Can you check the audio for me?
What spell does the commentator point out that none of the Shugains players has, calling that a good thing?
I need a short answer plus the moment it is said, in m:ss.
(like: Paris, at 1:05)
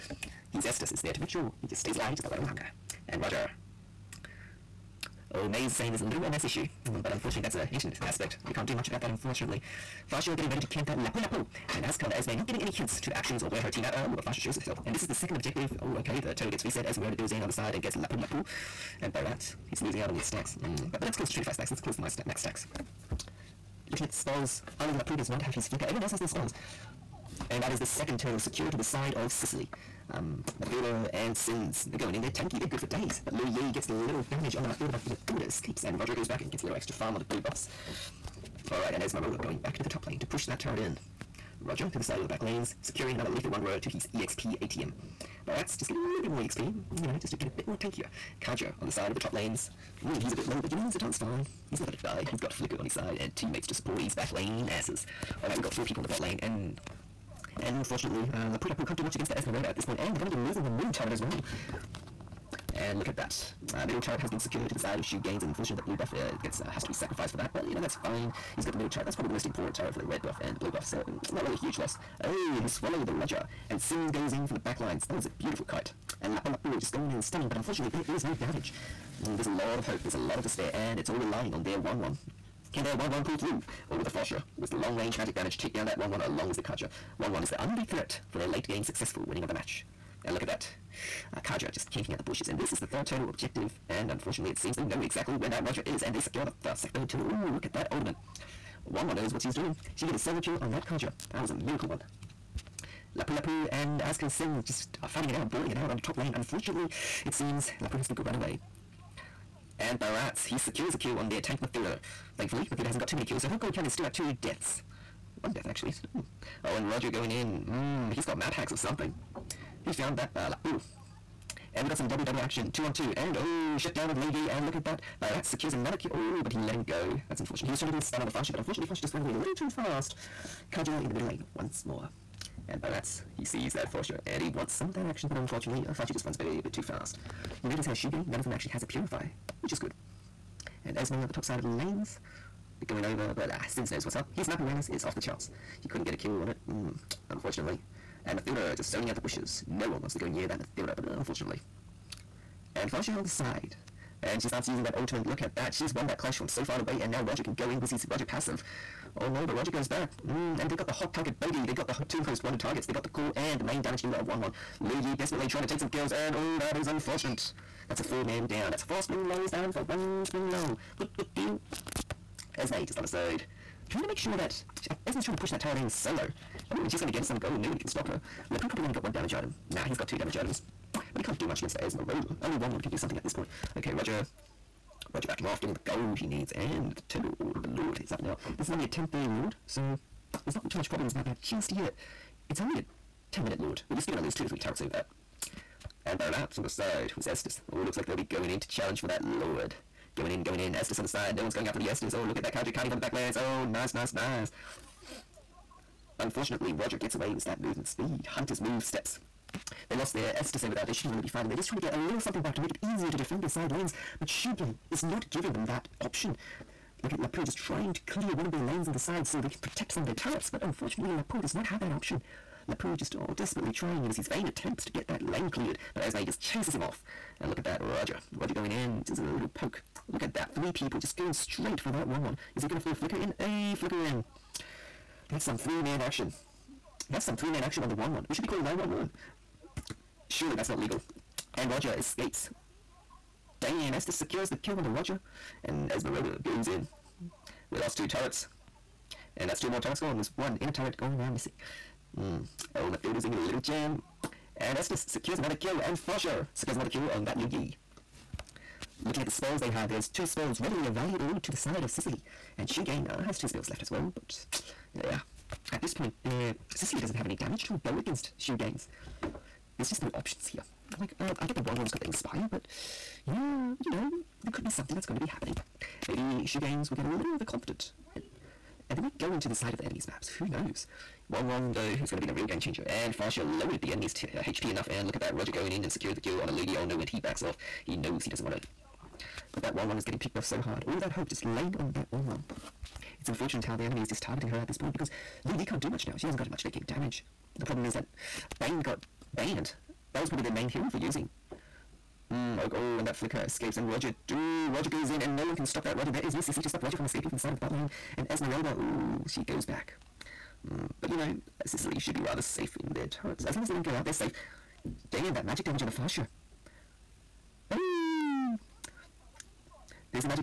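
Purify, at 2:18.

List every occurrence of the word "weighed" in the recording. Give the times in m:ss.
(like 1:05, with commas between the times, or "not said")
not said.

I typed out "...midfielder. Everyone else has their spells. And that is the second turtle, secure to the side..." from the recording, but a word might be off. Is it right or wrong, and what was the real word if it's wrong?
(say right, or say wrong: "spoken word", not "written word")
wrong: "flicker", not "midfielder".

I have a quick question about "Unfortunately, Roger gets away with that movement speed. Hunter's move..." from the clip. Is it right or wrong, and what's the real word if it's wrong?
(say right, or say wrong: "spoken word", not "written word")
right.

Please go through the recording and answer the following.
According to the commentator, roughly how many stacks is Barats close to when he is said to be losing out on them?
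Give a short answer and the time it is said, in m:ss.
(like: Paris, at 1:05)
25, at 0:21.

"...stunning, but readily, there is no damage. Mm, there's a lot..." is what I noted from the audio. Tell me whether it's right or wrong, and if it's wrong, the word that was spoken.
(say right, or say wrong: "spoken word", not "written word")
wrong: "unfortunately", not "readily".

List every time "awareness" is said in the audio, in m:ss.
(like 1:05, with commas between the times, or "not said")
2:24.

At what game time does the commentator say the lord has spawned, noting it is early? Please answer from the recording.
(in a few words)
10:30.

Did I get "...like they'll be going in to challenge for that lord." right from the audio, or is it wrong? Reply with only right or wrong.
right.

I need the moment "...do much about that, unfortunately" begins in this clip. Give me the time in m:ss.
0:08.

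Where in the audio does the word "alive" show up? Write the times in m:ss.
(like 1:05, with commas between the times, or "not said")
0:01.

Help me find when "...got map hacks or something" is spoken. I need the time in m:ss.
1:58.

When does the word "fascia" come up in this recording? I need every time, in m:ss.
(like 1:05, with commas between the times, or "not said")
5:15.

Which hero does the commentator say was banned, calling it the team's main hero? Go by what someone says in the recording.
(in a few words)
Bane.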